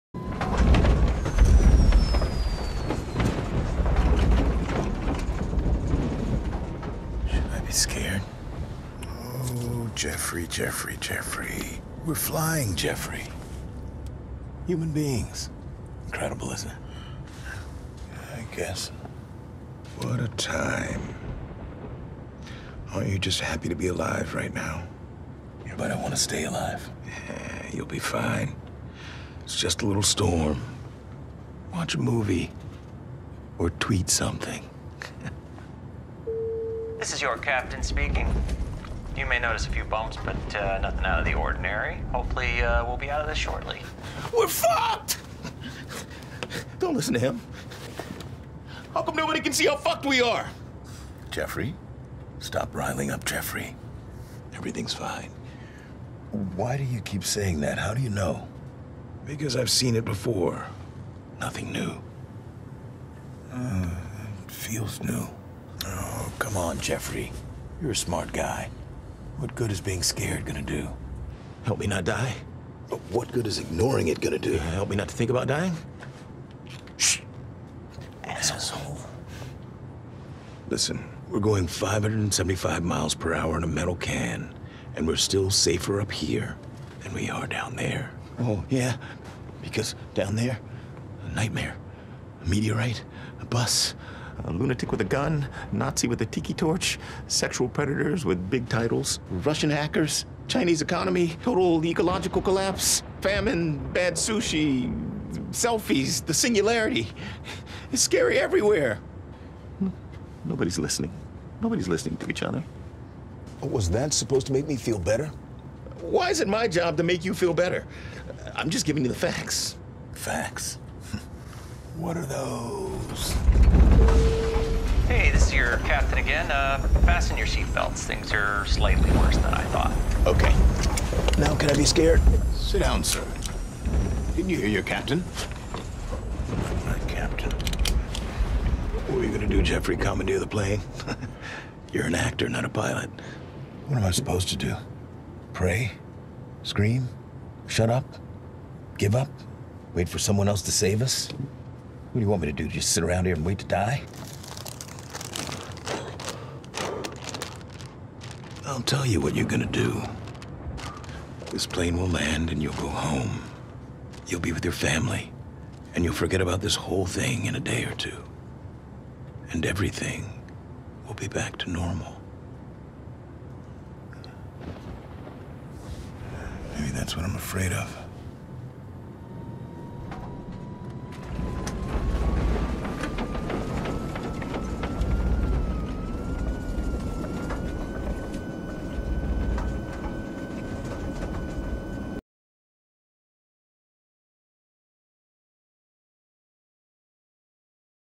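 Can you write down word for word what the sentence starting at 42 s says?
Hopefully, uh, we'll be out of this shortly.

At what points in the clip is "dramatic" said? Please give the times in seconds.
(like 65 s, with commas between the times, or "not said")
not said.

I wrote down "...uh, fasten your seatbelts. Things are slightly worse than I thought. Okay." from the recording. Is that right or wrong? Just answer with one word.
right.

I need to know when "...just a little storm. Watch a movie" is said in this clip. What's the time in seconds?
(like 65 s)
29 s.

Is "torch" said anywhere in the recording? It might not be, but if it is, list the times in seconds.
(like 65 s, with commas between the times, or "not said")
96 s.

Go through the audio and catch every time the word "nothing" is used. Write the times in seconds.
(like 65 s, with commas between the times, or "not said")
40 s, 61 s.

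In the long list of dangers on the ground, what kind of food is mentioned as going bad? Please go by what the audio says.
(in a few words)
Sushi.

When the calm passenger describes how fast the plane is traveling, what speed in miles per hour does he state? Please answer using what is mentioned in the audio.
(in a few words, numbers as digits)
575.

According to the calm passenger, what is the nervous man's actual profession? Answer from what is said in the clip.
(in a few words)
Actor.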